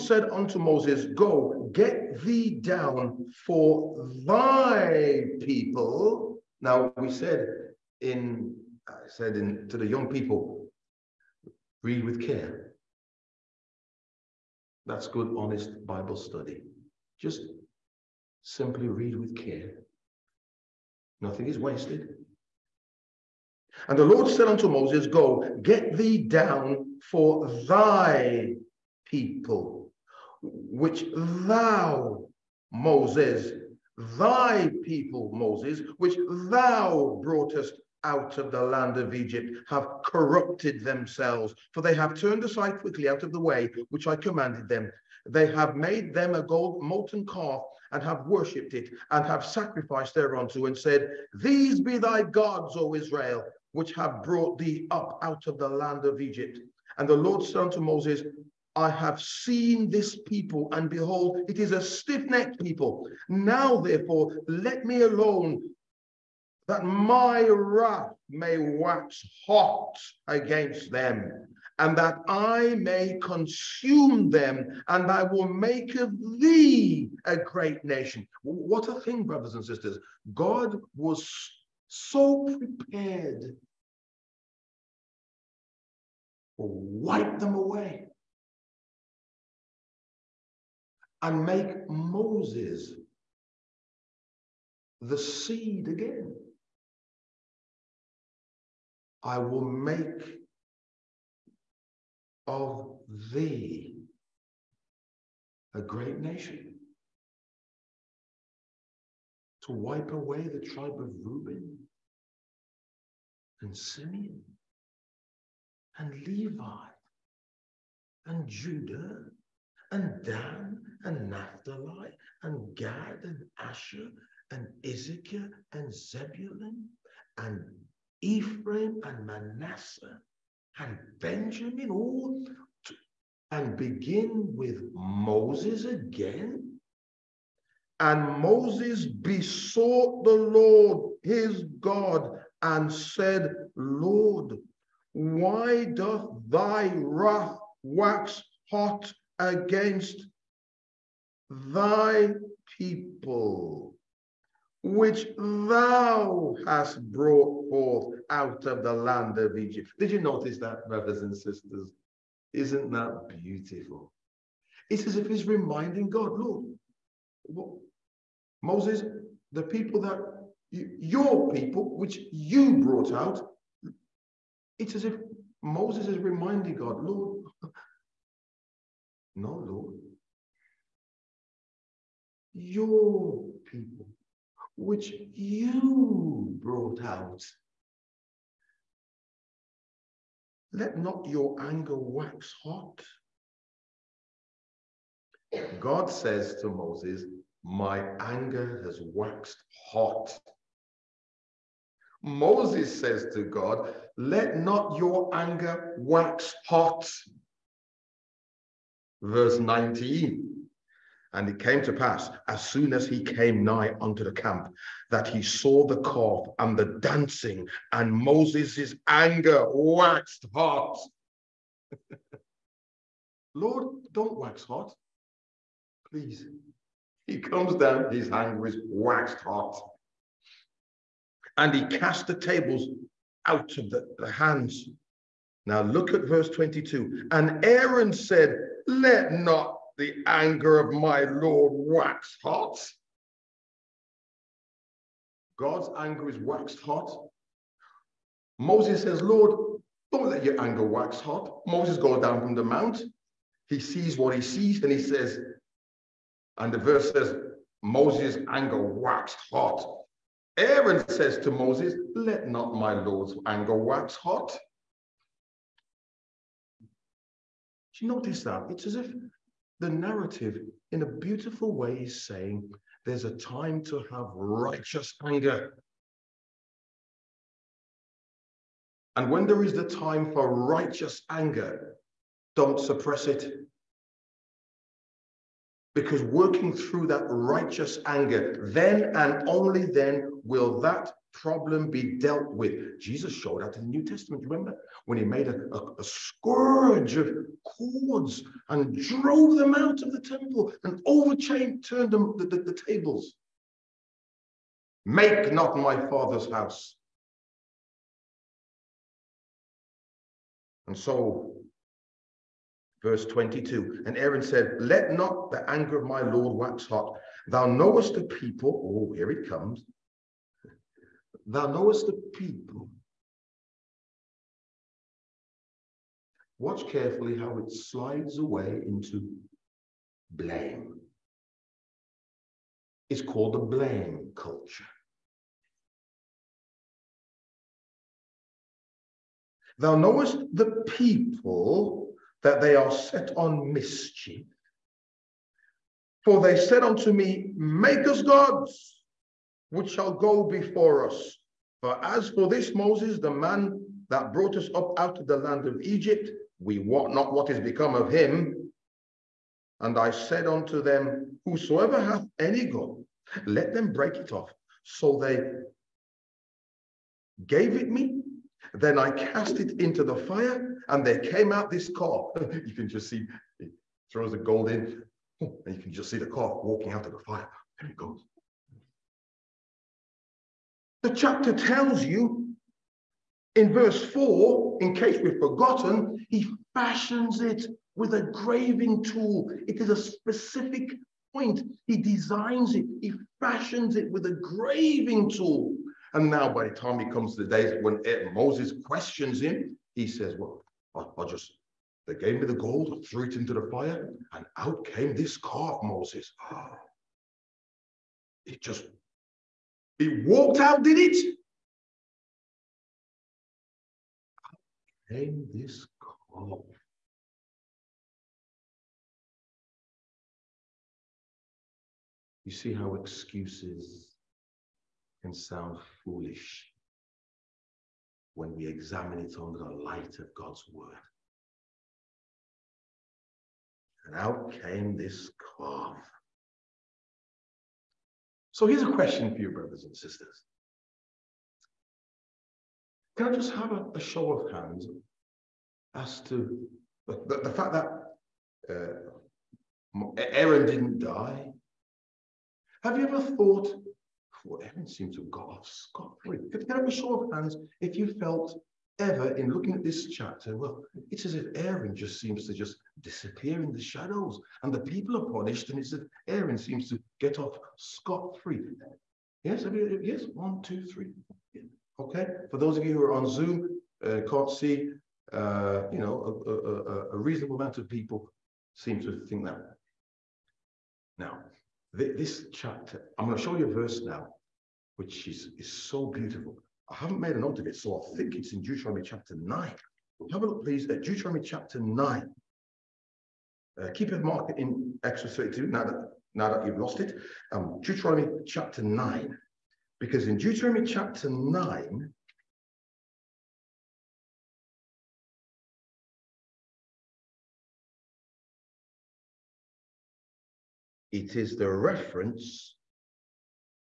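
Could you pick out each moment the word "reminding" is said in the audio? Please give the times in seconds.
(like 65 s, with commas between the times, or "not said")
165 s, 176 s.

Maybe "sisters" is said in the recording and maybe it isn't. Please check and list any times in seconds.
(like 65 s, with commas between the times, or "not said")
79 s, 161 s, 439 s.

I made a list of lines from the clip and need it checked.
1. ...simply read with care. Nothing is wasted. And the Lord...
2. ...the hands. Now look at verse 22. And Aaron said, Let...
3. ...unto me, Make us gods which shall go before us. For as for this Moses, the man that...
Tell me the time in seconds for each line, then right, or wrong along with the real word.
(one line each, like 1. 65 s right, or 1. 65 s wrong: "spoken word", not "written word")
1. 18 s right
2. 234 s right
3. 346 s right.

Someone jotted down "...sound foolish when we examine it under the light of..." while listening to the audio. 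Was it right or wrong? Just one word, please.
right.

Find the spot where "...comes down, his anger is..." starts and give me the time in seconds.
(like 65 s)
227 s.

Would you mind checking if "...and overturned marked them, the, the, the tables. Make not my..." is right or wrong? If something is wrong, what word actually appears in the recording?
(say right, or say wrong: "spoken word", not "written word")
wrong: "turned", not "marked".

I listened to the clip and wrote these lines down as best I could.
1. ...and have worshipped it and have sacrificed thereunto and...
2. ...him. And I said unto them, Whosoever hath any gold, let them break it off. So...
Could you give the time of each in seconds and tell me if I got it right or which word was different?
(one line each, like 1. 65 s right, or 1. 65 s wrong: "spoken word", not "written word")
1. 47 s right
2. 358 s right.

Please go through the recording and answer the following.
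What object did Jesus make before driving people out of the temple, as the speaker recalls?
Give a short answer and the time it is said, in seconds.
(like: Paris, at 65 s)
A scourge of cords, at 296 s.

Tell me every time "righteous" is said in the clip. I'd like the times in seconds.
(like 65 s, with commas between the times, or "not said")
274 s, 280 s, 287 s.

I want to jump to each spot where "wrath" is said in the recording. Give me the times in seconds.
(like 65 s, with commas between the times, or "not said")
67 s, 146 s.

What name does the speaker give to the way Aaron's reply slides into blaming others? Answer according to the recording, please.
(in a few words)
Blame culture.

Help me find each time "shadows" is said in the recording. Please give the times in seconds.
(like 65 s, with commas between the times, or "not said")
463 s.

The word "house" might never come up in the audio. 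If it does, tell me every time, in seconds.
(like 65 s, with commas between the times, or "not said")
306 s.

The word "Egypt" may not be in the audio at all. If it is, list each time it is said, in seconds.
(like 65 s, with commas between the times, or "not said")
39 s, 56 s, 159 s, 355 s.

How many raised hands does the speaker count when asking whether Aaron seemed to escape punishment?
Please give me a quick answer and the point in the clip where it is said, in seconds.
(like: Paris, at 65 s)
3, at 470 s.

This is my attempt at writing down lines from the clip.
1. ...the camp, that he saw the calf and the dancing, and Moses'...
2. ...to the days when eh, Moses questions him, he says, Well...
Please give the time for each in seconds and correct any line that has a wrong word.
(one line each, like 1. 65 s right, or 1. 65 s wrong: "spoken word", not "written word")
1. 214 s right
2. 397 s right.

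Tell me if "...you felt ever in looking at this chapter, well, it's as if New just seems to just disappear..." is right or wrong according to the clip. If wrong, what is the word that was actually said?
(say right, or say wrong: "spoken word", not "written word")
wrong: "Aaron", not "New".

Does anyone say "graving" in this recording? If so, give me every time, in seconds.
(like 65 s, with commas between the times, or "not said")
388 s, 394 s.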